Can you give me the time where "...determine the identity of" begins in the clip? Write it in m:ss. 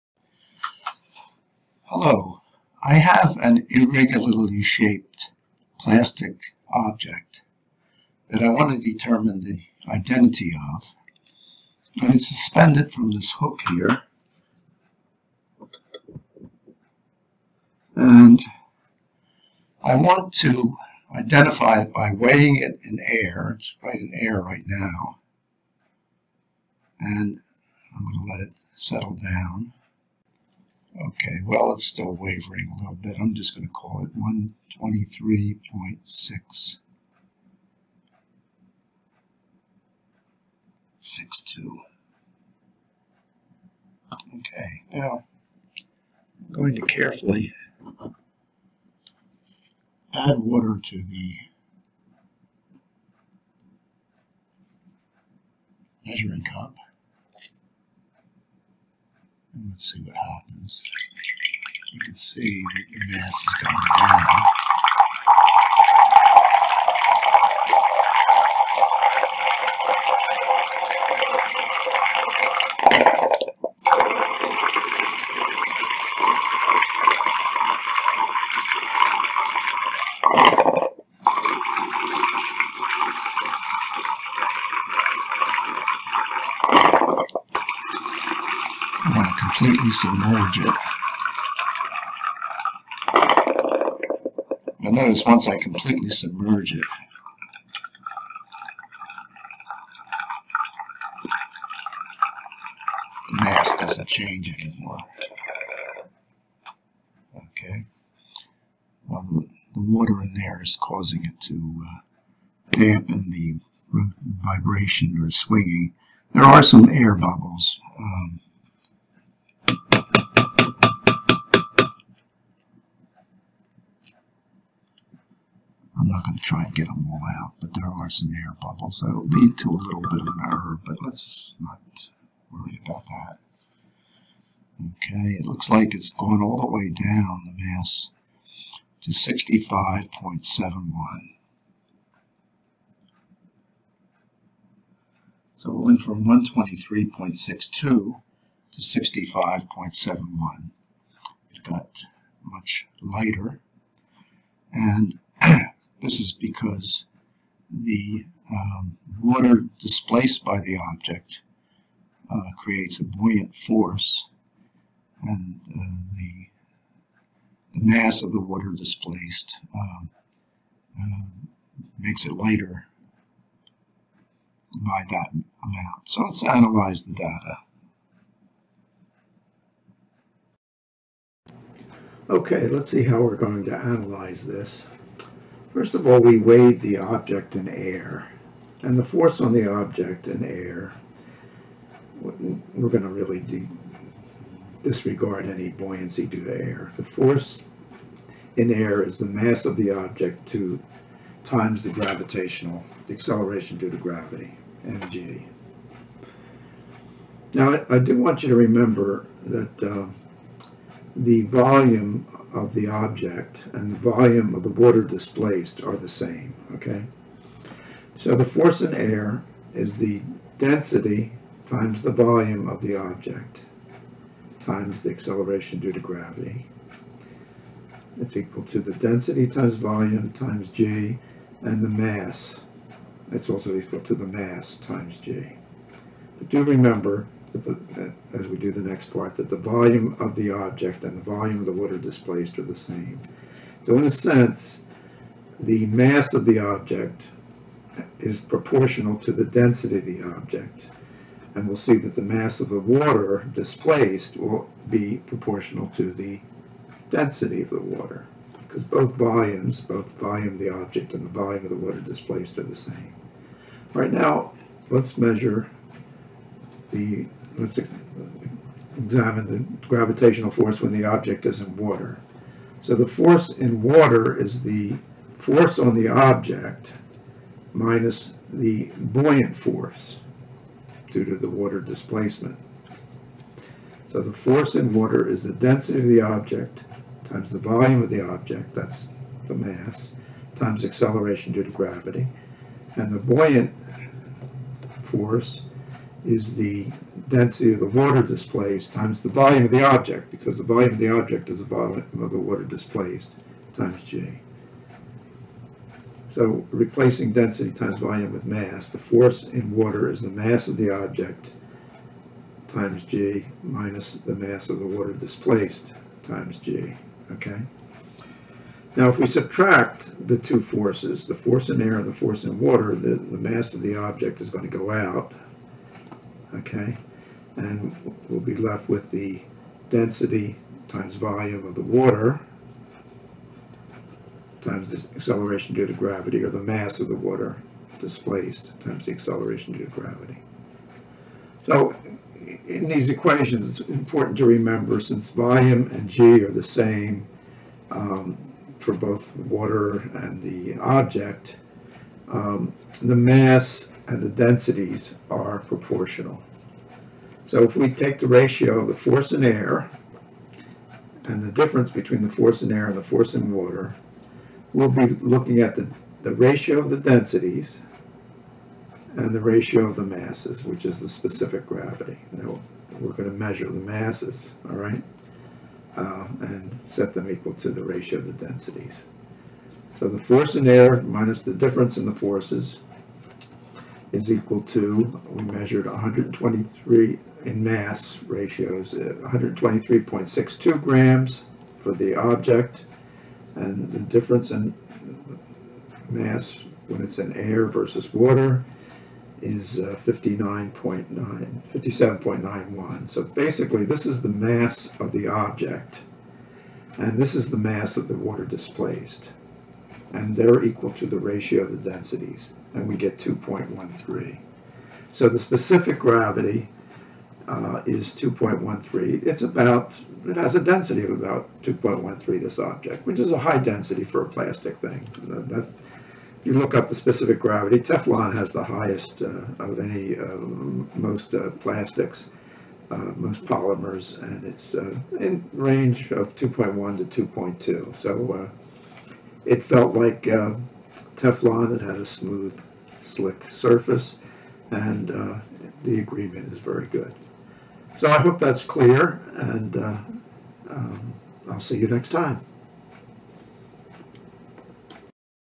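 0:08.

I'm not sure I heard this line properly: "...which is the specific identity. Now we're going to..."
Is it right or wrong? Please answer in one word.
wrong.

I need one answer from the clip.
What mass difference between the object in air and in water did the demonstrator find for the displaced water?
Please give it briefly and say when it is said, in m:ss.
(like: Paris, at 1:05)
57.91, at 6:41.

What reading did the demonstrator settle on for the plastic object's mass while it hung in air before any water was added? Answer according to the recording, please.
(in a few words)
123.662.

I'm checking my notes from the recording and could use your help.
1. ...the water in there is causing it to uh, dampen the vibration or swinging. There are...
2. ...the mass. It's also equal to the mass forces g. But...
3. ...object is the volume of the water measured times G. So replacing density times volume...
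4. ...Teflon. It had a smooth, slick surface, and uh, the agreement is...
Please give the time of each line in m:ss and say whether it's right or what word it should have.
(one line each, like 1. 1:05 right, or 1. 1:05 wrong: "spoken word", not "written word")
1. 1:49 right
2. 3:51 wrong: "times", not "forces"
3. 5:01 wrong: "displaced", not "measured"
4. 7:21 right.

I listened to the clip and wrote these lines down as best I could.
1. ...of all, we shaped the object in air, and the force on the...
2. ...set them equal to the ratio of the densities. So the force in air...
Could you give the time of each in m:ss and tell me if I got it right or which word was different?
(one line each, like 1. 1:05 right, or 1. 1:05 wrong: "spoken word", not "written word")
1. 3:05 wrong: "weighed", not "shaped"
2. 6:16 right.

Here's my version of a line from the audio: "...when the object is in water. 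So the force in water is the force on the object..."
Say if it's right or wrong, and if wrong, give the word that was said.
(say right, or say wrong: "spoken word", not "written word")
right.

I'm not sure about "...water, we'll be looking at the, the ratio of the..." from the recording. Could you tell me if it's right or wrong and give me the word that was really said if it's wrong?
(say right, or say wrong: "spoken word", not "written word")
right.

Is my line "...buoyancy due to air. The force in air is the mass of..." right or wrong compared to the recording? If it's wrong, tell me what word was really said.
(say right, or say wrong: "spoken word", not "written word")
right.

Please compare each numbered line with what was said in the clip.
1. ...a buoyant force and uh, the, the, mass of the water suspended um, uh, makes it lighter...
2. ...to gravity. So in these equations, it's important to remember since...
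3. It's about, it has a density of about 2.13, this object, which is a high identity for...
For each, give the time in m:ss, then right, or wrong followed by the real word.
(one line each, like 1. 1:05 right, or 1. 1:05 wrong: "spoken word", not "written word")
1. 2:42 wrong: "displaced", not "suspended"
2. 5:39 right
3. 6:59 wrong: "density", not "identity".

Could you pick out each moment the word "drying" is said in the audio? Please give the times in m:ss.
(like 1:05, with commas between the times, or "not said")
not said.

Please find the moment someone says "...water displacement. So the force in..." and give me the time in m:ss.
4:41.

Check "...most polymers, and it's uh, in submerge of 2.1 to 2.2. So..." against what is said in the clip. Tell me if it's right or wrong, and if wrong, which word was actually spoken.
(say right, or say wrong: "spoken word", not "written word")
wrong: "range", not "submerge".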